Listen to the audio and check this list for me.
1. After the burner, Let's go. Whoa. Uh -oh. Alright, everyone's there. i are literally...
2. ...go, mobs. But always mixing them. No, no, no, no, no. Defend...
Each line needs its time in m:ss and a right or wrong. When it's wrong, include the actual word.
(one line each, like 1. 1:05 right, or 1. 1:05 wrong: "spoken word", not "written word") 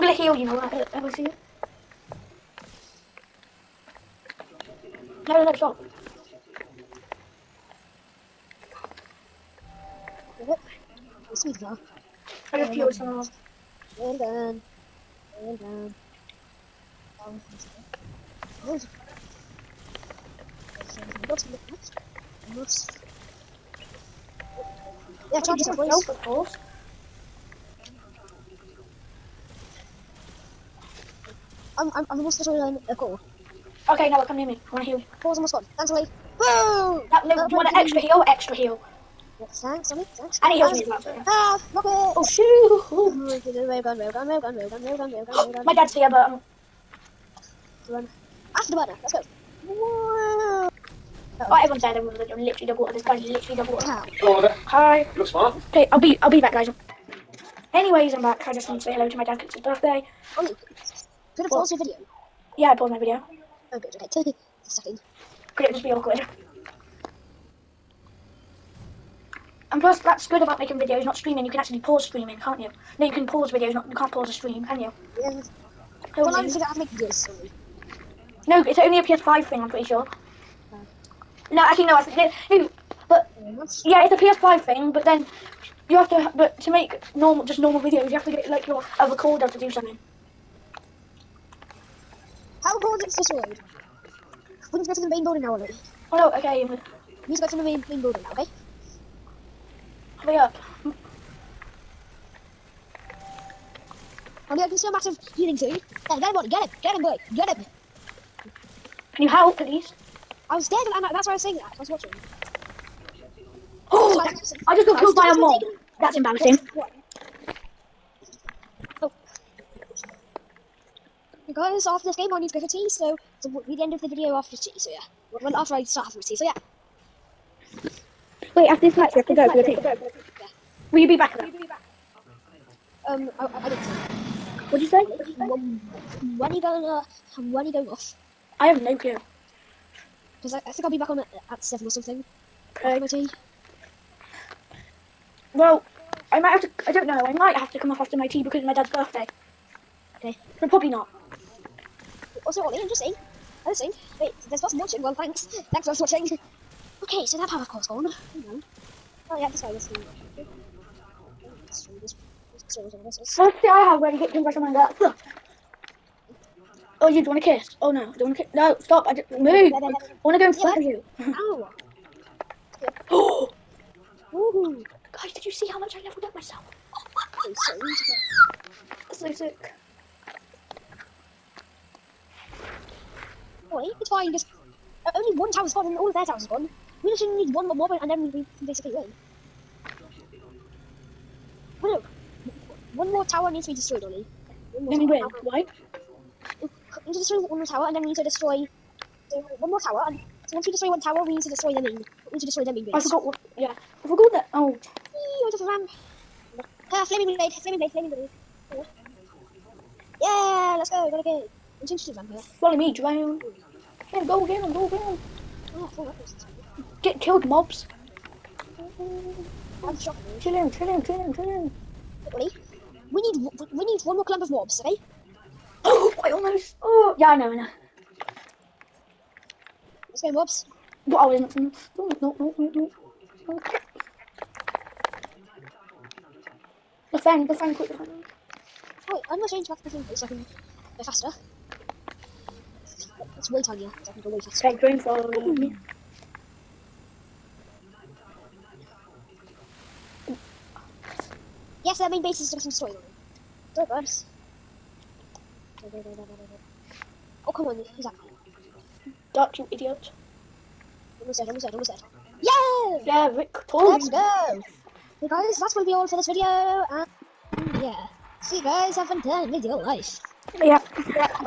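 1. 0:48 right
2. 3:50 right.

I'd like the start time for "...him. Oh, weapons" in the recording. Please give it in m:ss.
3:34.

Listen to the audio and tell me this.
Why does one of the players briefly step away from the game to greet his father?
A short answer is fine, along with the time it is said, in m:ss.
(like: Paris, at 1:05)
his birthday, at 0:59.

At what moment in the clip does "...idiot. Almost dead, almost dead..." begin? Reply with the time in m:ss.
4:19.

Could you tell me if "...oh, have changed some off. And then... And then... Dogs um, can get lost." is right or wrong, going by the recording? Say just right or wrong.
wrong.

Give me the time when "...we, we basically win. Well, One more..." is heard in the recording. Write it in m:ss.
3:08.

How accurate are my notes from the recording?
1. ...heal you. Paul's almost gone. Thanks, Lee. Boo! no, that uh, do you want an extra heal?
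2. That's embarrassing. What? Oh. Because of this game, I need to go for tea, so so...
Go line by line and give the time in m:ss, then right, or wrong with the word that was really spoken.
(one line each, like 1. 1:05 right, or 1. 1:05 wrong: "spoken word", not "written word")
1. 0:34 right
2. 1:56 right.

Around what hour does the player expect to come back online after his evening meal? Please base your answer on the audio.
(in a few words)
7.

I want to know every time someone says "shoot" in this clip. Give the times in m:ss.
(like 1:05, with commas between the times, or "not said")
0:42.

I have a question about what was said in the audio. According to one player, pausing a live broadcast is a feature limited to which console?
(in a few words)
PS5.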